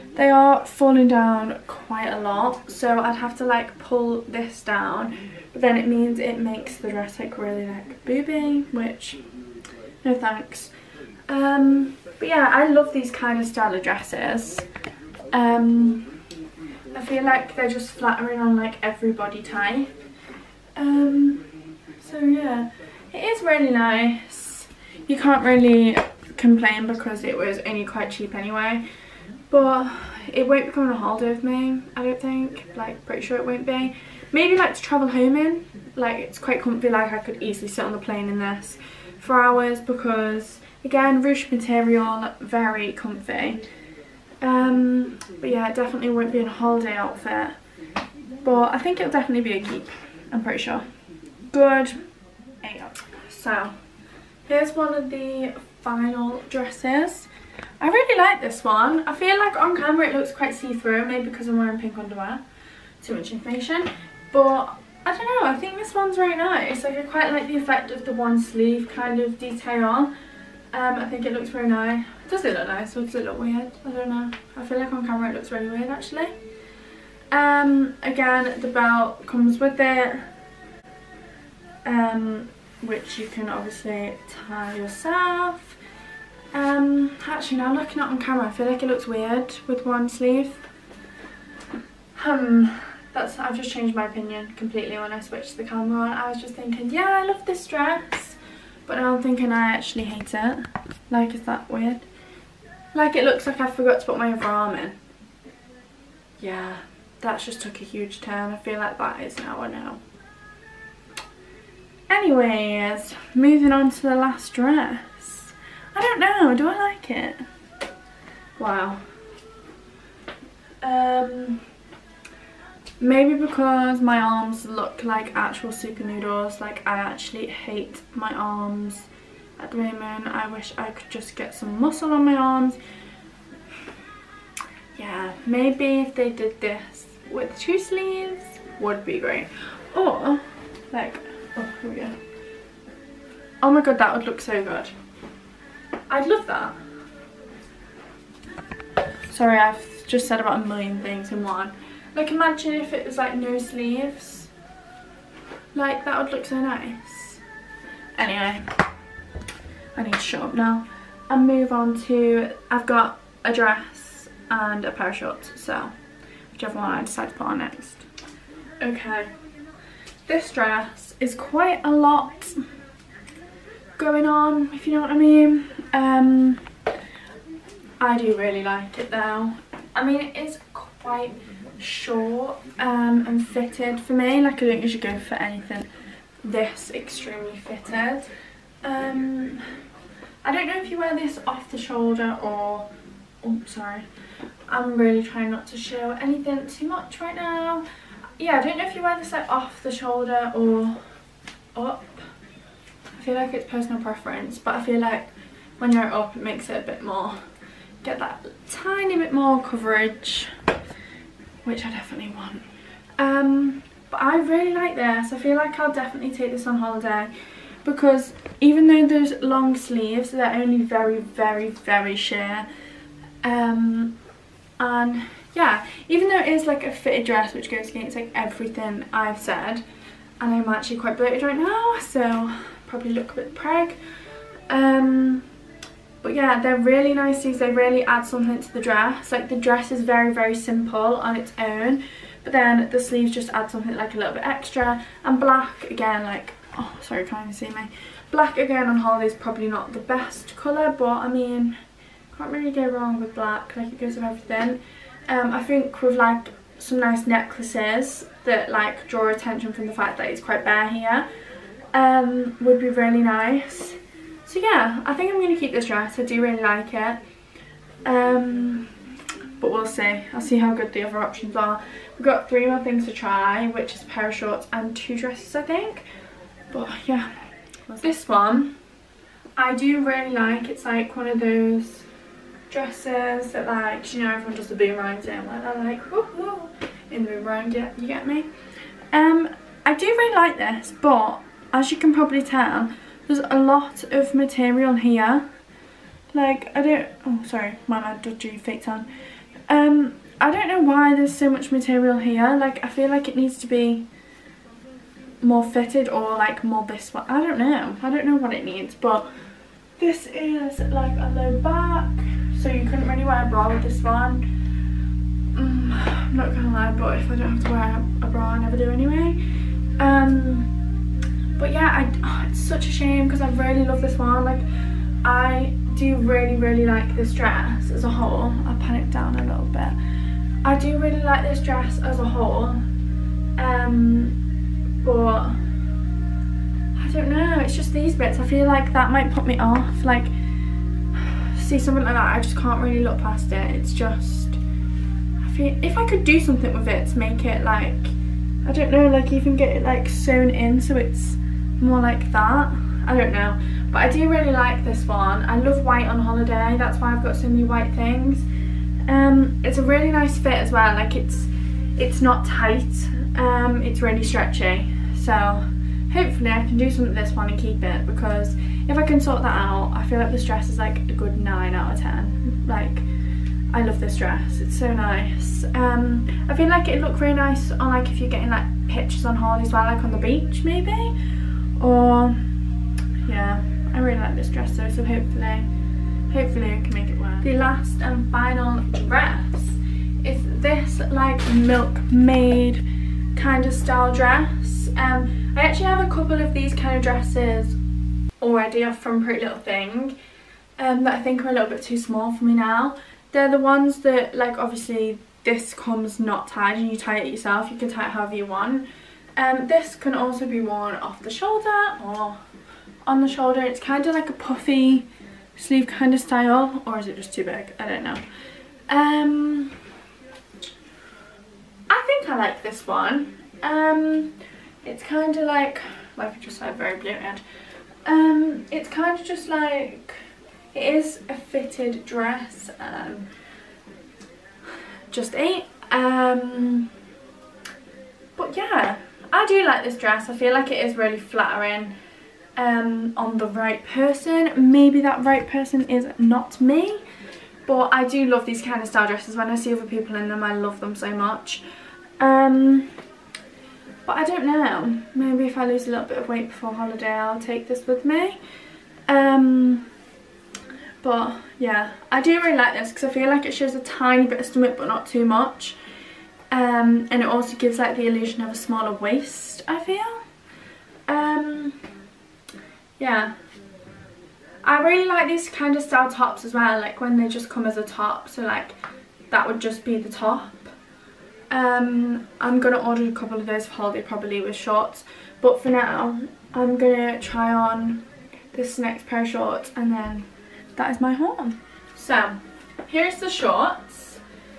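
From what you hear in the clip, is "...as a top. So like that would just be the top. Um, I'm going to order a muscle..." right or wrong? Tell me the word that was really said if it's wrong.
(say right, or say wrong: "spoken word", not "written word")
wrong: "couple", not "muscle".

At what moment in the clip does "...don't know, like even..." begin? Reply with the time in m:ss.
5:48.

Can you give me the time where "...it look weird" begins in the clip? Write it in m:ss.
1:13.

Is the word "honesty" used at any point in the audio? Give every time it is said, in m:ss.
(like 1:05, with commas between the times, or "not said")
not said.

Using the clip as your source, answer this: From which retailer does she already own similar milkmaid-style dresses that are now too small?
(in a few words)
Pretty Little Thing.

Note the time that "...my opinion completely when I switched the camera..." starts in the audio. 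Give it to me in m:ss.
1:33.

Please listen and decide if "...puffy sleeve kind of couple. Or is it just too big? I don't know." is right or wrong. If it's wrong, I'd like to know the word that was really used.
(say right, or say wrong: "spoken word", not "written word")
wrong: "style", not "couple".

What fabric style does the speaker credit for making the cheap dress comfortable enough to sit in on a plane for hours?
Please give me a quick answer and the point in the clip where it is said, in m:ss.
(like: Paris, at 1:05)
ruche, at 0:41.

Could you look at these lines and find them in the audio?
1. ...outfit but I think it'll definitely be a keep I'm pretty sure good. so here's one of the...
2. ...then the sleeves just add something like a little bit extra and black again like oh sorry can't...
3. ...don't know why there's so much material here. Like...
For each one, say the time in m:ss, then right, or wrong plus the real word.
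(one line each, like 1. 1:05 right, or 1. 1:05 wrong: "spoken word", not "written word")
1. 0:46 right
2. 4:02 right
3. 5:00 right.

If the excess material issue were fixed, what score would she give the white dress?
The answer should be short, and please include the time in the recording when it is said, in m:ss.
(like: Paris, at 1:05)
9 out of 10, at 6:11.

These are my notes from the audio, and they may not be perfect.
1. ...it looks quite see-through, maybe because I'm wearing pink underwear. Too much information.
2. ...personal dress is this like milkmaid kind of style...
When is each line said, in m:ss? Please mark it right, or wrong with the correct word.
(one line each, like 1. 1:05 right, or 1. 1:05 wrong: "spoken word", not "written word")
1. 1:00 right
2. 6:28 wrong: "final", not "personal".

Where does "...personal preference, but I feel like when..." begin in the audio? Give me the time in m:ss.
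3:23.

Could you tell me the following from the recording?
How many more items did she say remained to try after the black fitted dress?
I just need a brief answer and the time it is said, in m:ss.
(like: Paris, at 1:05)
3, at 4:32.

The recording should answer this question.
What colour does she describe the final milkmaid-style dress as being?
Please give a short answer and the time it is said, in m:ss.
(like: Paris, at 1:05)
blue, at 7:06.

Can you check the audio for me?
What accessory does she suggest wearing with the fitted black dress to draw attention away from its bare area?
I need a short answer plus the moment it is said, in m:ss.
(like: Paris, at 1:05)
necklaces, at 4:17.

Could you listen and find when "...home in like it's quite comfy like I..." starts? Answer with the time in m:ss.
0:35.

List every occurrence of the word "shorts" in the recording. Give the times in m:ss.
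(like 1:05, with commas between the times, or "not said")
2:45, 3:01, 4:34, 8:04, 8:09, 8:13.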